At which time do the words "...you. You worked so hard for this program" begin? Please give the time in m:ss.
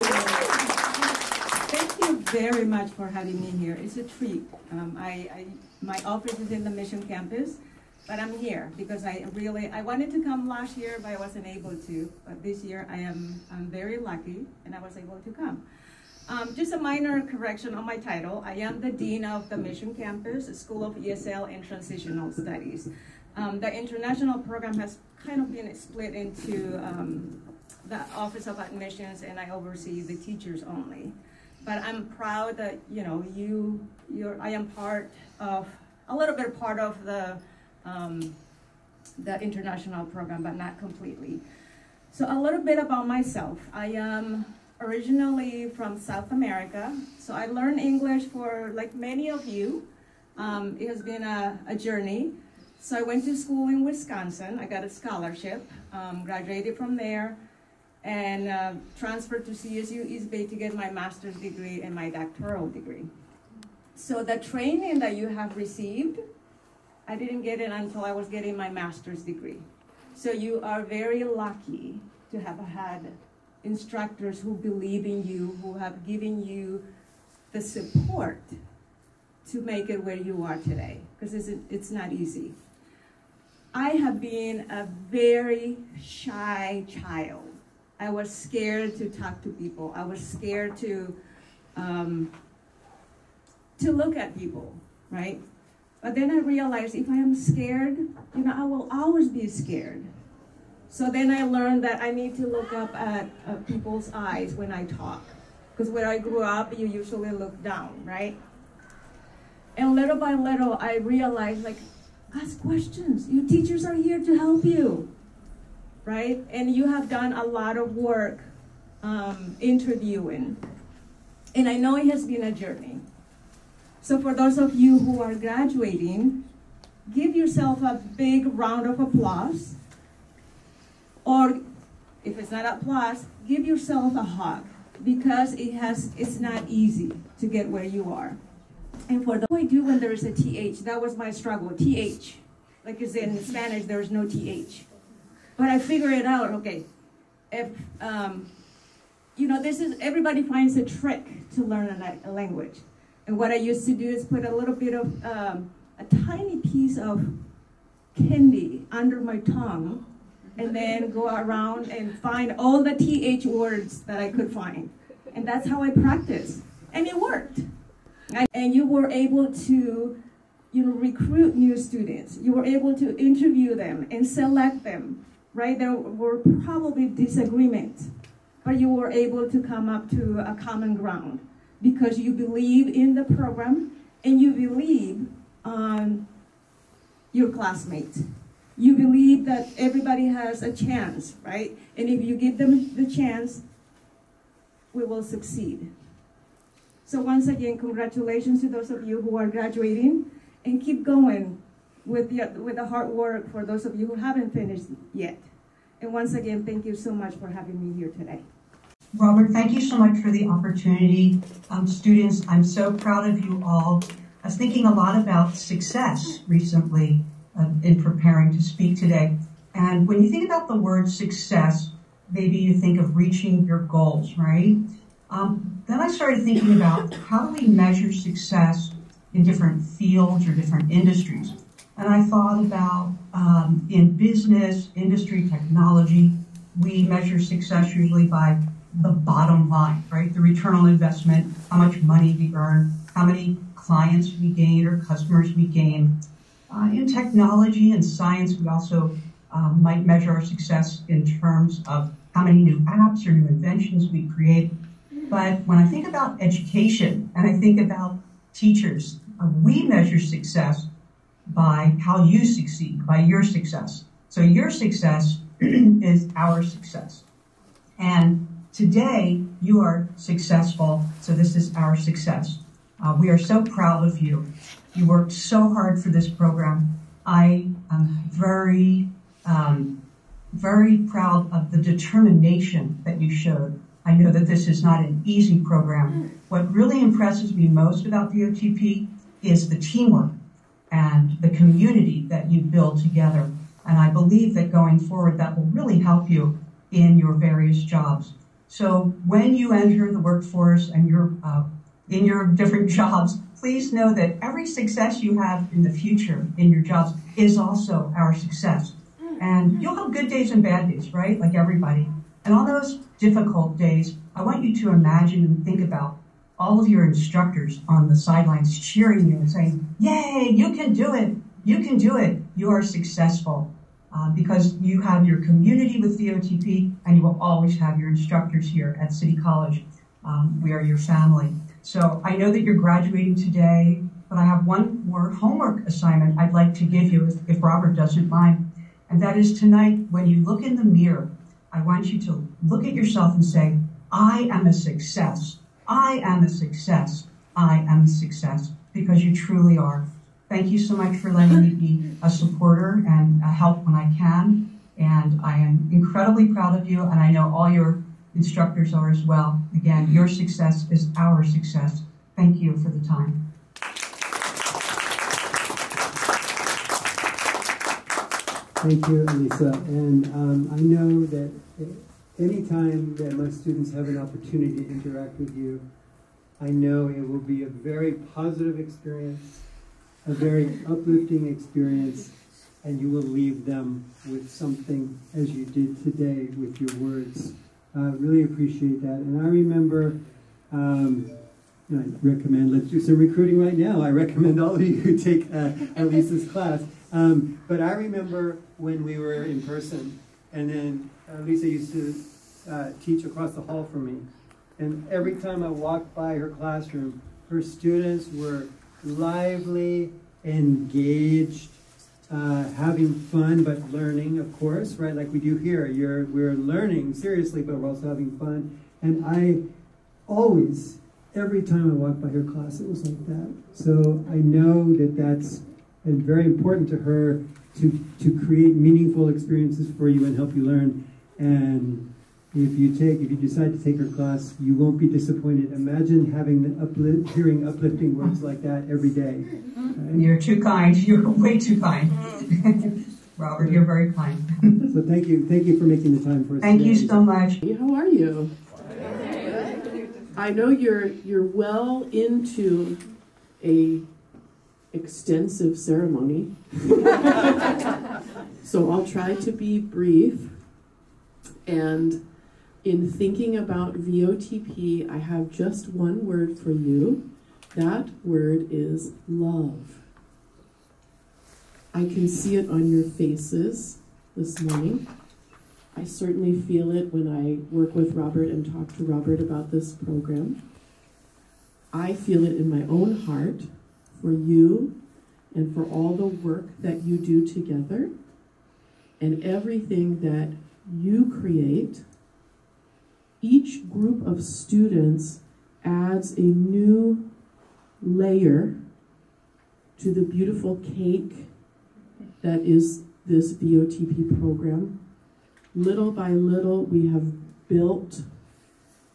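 4:34.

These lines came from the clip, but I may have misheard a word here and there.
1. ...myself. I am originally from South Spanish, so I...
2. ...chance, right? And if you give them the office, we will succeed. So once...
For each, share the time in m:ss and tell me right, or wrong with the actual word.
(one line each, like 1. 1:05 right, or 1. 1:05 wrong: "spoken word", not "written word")
1. 0:43 wrong: "America", not "Spanish"
2. 3:10 wrong: "chance", not "office".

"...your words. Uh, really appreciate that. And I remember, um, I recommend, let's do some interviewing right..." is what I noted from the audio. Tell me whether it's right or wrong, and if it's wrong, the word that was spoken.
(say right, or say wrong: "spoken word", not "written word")
wrong: "recruiting", not "interviewing".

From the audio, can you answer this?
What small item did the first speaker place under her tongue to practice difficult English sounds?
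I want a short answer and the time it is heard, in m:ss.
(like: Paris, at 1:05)
candy, at 2:38.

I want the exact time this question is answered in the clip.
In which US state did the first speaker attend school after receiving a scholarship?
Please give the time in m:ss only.
0:53.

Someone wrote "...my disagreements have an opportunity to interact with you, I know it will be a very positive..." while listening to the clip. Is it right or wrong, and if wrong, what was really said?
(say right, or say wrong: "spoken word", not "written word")
wrong: "students", not "disagreements".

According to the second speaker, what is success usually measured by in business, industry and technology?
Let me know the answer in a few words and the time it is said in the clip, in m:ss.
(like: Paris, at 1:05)
the bottom line, at 3:59.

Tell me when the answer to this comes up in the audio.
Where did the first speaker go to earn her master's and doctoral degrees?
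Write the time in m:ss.
0:59.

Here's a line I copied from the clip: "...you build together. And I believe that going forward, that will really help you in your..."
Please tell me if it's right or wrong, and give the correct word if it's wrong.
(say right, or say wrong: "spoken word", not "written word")
right.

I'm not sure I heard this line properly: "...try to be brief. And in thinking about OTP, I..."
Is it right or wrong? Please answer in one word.
wrong.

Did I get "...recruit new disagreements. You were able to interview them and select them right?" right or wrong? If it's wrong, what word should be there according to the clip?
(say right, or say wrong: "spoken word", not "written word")
wrong: "students", not "disagreements".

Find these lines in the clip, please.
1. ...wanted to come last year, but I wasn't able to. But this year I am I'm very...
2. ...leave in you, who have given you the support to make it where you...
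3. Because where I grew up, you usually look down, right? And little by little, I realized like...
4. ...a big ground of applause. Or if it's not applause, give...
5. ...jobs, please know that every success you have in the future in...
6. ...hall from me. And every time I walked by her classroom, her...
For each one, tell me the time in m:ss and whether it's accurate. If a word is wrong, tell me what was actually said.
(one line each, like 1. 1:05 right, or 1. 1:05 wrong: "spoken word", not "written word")
1. 0:09 right
2. 1:14 wrong: "believe", not "leave"
3. 1:45 right
4. 2:07 wrong: "round", not "ground"
5. 5:02 right
6. 6:43 right.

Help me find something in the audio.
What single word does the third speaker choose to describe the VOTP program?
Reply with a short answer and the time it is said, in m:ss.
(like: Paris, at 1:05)
love, at 7:49.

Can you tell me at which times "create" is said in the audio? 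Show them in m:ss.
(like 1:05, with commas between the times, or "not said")
4:14, 7:08, 8:11.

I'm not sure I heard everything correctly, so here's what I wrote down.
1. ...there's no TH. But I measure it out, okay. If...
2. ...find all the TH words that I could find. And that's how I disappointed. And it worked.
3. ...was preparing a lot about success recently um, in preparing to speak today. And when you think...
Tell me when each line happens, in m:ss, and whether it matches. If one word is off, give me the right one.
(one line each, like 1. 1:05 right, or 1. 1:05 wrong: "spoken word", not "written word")
1. 2:23 wrong: "figure", not "measure"
2. 2:42 wrong: "practiced", not "disappointed"
3. 3:34 wrong: "thinking", not "preparing".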